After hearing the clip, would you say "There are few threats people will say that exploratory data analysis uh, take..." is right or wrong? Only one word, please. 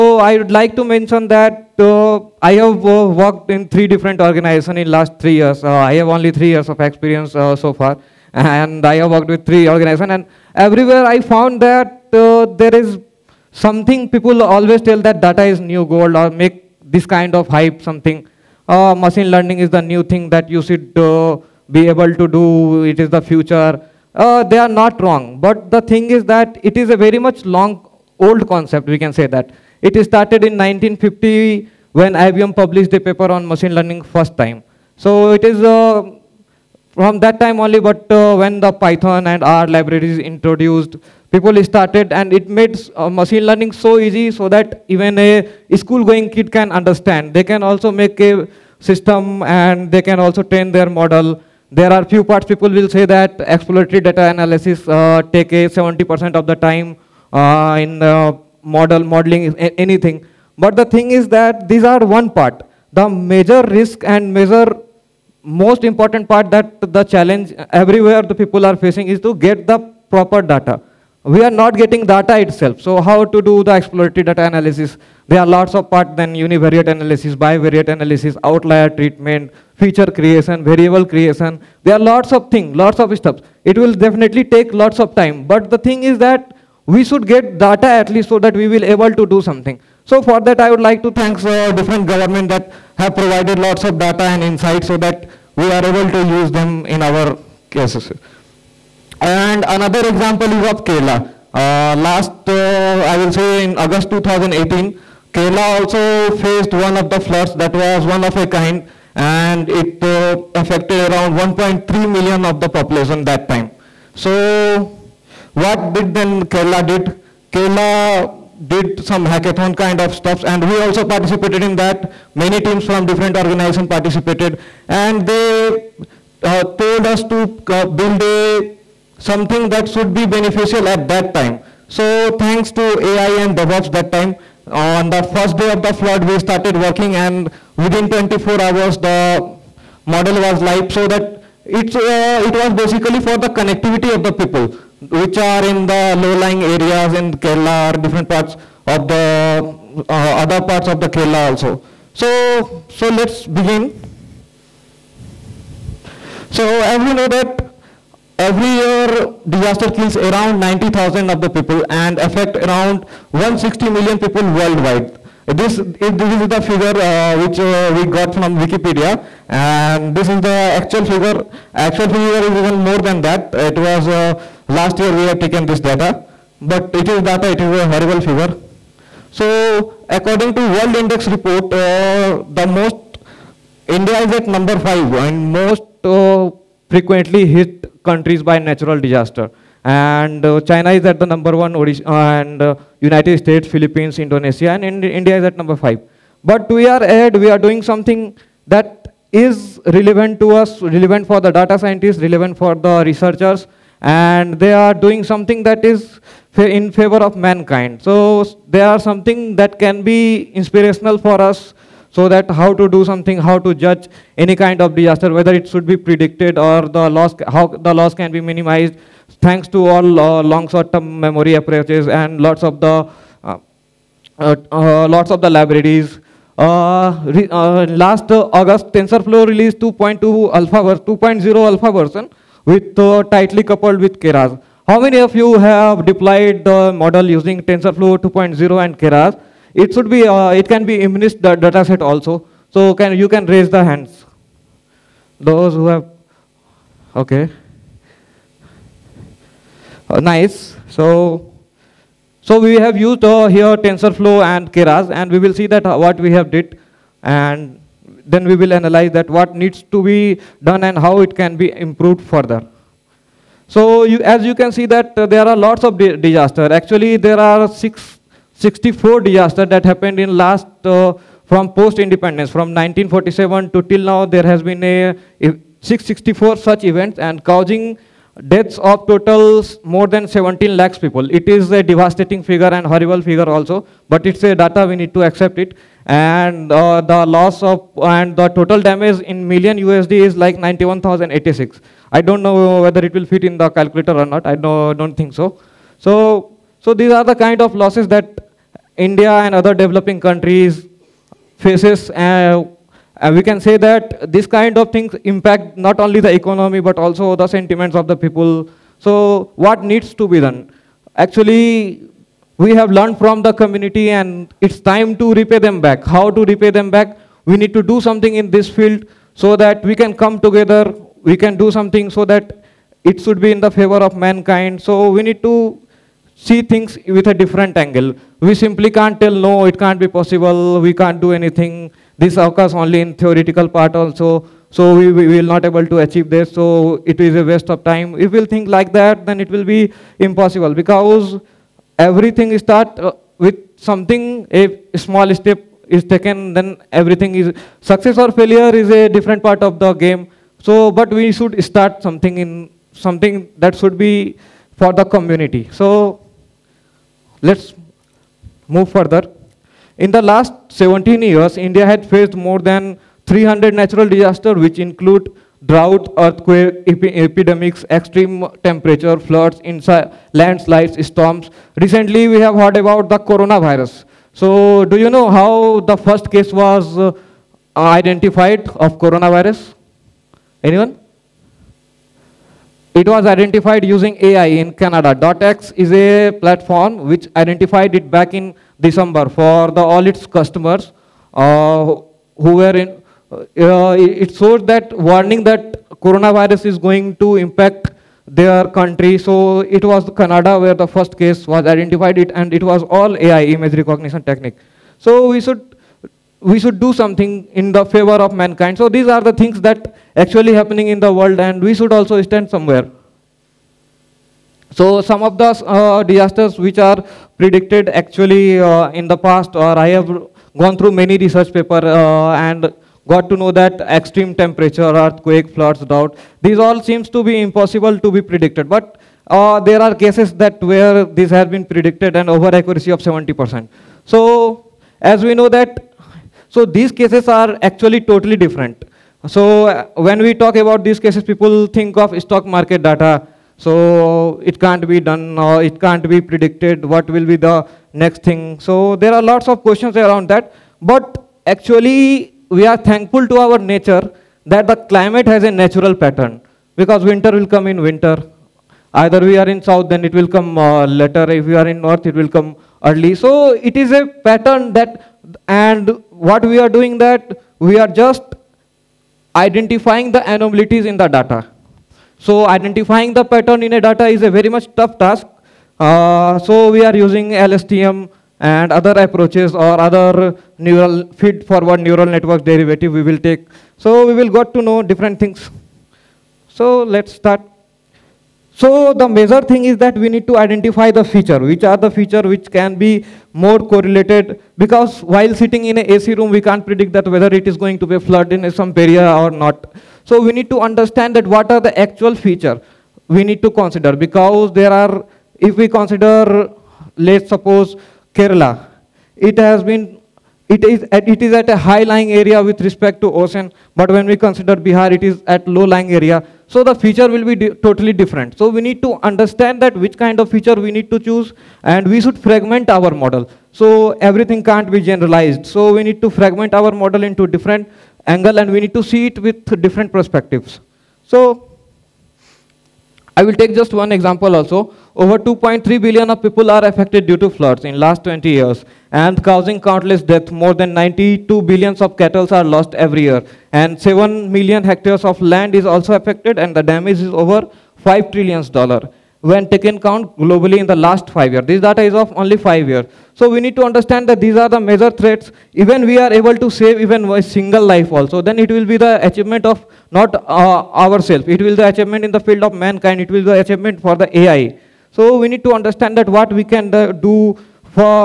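wrong.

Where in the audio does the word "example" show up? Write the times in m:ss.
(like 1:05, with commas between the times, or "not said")
1:40, 8:53.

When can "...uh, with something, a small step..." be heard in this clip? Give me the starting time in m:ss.
5:42.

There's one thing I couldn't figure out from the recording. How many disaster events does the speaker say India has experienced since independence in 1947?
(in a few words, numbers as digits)
664.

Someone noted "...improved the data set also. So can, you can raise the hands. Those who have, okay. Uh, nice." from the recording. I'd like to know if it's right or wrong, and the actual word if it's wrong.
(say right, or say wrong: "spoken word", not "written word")
wrong: "immunized", not "improved".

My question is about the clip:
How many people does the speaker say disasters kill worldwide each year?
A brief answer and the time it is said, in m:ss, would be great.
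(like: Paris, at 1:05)
90,000, at 2:40.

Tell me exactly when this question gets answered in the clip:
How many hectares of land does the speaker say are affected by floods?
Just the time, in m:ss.
9:03.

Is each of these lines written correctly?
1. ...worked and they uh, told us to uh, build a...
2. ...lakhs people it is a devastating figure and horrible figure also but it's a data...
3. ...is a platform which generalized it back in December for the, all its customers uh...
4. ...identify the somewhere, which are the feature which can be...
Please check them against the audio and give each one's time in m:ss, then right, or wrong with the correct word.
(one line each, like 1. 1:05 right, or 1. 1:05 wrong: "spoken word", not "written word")
1. 2:03 wrong: "participated", not "worked"
2. 4:40 right
3. 6:25 wrong: "identified", not "generalized"
4. 8:10 wrong: "feature", not "somewhere".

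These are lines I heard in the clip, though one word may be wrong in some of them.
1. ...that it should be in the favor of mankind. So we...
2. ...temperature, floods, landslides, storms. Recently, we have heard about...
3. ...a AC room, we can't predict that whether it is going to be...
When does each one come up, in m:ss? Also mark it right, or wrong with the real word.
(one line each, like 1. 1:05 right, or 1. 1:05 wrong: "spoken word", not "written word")
1. 5:22 right
2. 6:08 right
3. 8:15 right.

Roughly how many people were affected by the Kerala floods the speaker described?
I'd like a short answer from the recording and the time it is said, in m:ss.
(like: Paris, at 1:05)
1.3 million, at 1:51.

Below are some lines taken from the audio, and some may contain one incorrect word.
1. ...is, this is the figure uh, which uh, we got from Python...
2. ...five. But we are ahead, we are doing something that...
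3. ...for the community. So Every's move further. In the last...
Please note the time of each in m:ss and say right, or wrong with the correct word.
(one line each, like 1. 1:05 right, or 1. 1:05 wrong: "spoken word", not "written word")
1. 2:45 wrong: "Wikipedia", not "Python"
2. 3:15 right
3. 5:54 wrong: "Let", not "Every".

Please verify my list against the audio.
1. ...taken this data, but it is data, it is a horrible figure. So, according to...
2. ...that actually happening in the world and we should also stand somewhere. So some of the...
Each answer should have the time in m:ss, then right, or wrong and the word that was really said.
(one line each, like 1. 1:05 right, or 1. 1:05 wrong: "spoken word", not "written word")
1. 2:55 right
2. 6:49 right.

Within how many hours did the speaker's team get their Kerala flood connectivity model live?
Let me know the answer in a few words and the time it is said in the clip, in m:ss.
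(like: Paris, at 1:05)
24 hours, at 2:18.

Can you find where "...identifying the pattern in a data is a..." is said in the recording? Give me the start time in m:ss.
7:52.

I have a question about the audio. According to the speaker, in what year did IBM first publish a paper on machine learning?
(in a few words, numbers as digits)
1950.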